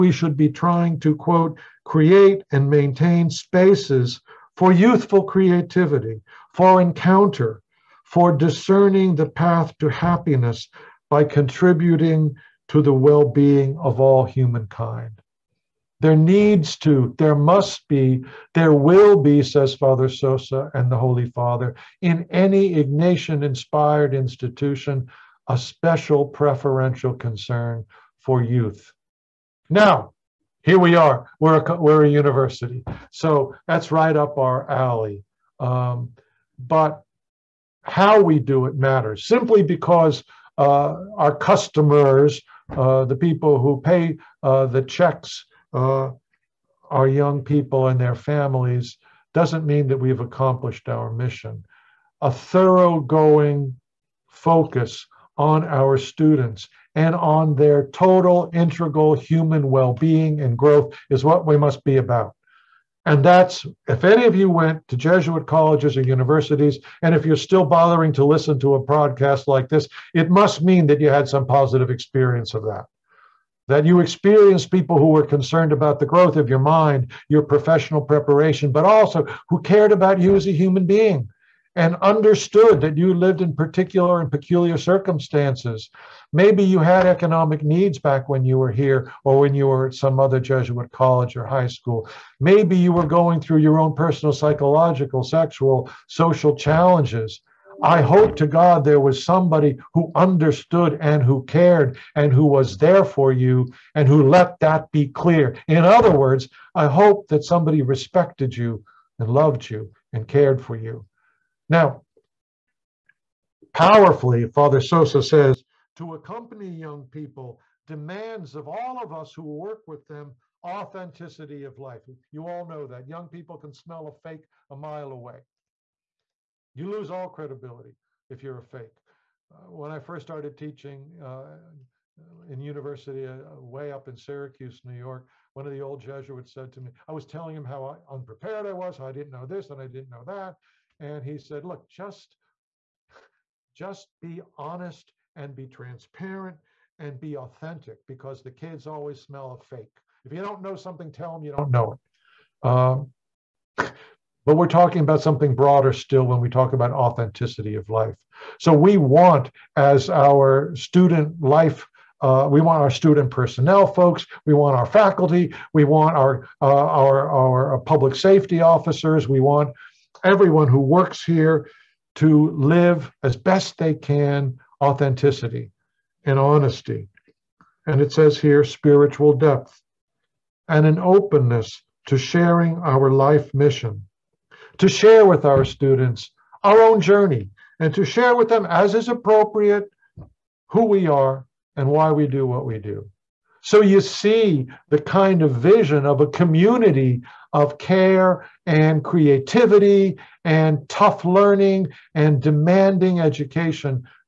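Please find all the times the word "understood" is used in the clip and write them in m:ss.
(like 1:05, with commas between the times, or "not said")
1:21, 1:40.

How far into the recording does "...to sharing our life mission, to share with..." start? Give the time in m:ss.
3:02.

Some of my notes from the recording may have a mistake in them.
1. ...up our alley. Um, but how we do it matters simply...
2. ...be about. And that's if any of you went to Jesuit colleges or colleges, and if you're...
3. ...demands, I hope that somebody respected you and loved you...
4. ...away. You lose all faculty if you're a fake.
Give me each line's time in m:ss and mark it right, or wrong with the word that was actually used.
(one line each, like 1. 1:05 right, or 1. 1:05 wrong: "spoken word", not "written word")
1. 0:34 right
2. 1:01 wrong: "universities", not "colleges"
3. 1:46 wrong: "words", not "demands"
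4. 2:05 wrong: "credibility", not "faculty".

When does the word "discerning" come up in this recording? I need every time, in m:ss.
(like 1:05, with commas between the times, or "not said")
0:08.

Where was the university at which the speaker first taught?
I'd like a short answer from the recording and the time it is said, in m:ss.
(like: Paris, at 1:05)
Syracuse, New York, at 2:14.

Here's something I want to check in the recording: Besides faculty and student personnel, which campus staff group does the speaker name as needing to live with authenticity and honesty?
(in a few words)
Public safety officers.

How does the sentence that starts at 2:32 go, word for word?
Um, but we're talking about something broader still when we talk about authenticity of life.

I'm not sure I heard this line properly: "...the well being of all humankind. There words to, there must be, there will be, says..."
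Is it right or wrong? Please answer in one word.
wrong.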